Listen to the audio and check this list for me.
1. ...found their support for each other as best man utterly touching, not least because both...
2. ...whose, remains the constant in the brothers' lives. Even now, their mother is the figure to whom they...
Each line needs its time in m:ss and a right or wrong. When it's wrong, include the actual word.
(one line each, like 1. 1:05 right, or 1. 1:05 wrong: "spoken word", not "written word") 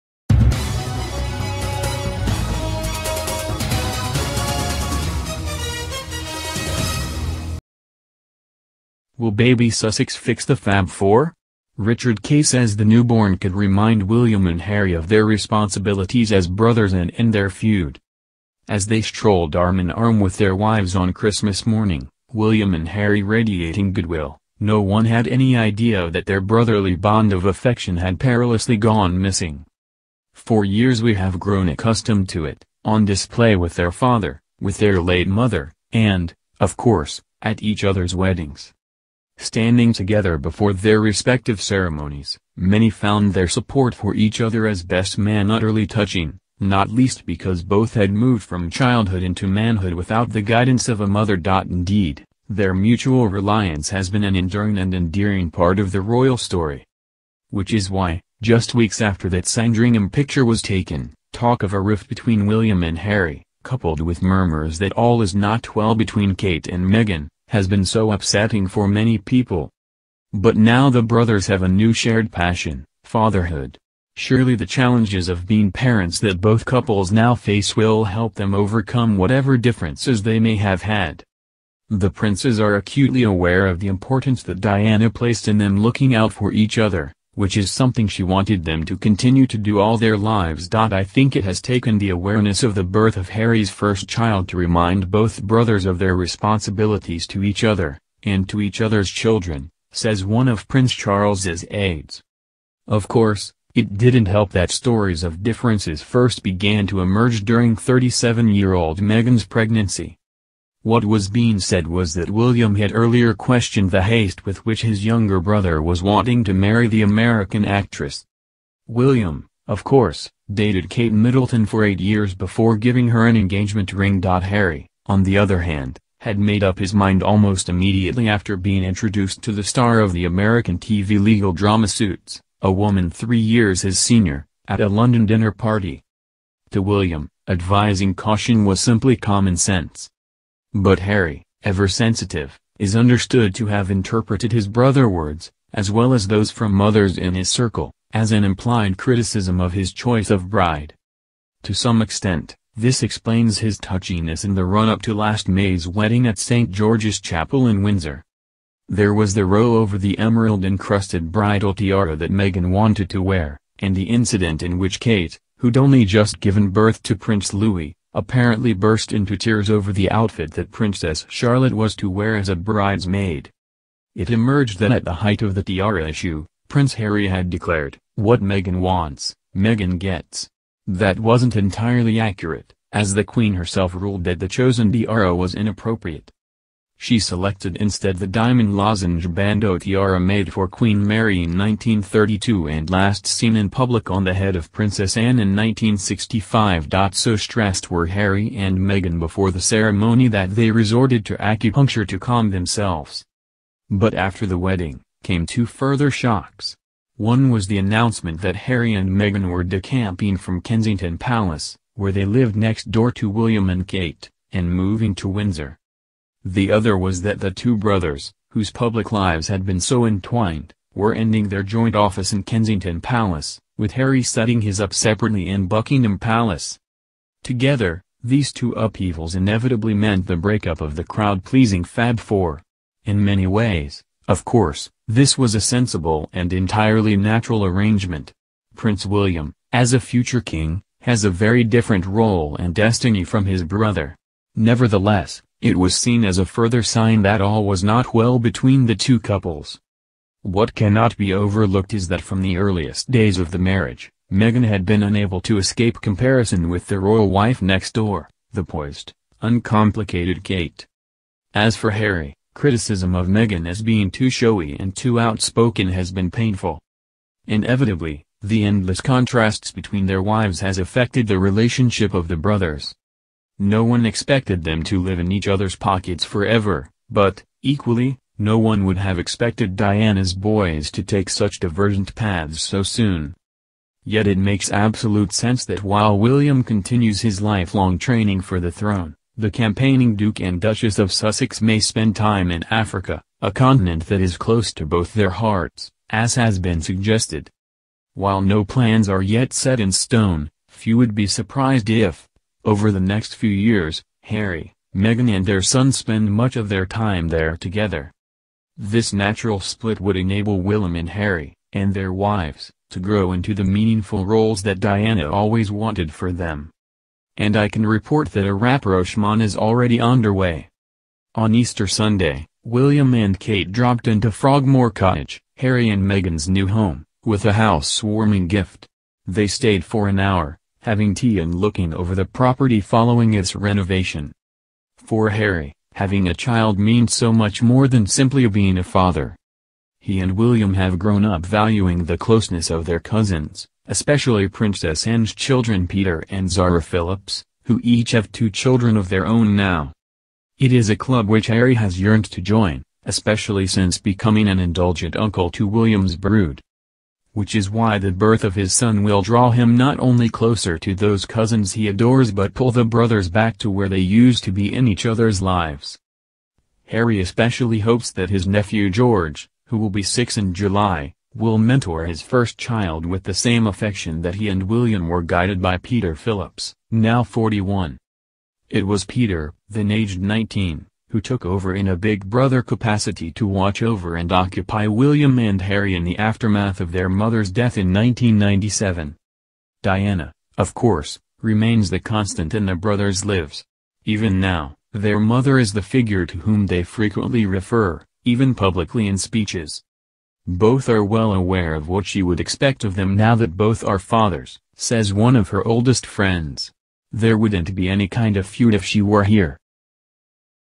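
1. 0:42 right
2. 6:30 wrong: "course", not "whose".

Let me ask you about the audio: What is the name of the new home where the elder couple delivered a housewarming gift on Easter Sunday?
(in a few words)
Frogmore Cottage.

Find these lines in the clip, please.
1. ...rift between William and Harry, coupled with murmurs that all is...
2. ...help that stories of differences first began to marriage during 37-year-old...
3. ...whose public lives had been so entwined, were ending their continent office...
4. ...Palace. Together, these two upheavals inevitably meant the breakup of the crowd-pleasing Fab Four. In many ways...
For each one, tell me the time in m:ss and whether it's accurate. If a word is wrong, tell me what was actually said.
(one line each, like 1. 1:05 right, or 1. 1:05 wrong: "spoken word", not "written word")
1. 1:01 right
2. 1:44 wrong: "emerge", not "marriage"
3. 3:38 wrong: "joint", not "continent"
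4. 3:46 right.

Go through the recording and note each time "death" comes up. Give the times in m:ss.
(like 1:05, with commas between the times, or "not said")
6:27.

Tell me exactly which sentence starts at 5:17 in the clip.
And I can report that a rapprochement is already underway.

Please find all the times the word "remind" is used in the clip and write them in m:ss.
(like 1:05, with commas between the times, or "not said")
0:13, 1:34.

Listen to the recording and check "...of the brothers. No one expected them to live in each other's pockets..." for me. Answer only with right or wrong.
right.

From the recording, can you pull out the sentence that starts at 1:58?
William, of course, dated Kate Middleton for eight years before giving her an engagement ring.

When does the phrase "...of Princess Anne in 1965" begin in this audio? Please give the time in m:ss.
3:14.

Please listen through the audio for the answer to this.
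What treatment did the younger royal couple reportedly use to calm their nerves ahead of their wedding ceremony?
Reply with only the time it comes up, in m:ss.
3:21.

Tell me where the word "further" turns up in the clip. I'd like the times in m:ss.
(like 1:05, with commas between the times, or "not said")
3:25, 4:06.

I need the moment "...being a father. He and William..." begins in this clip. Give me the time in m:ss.
5:38.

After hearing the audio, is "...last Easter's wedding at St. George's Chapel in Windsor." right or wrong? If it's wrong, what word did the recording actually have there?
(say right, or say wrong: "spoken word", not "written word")
wrong: "May", not "Easter".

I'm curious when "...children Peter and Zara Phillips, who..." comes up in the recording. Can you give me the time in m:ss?
5:45.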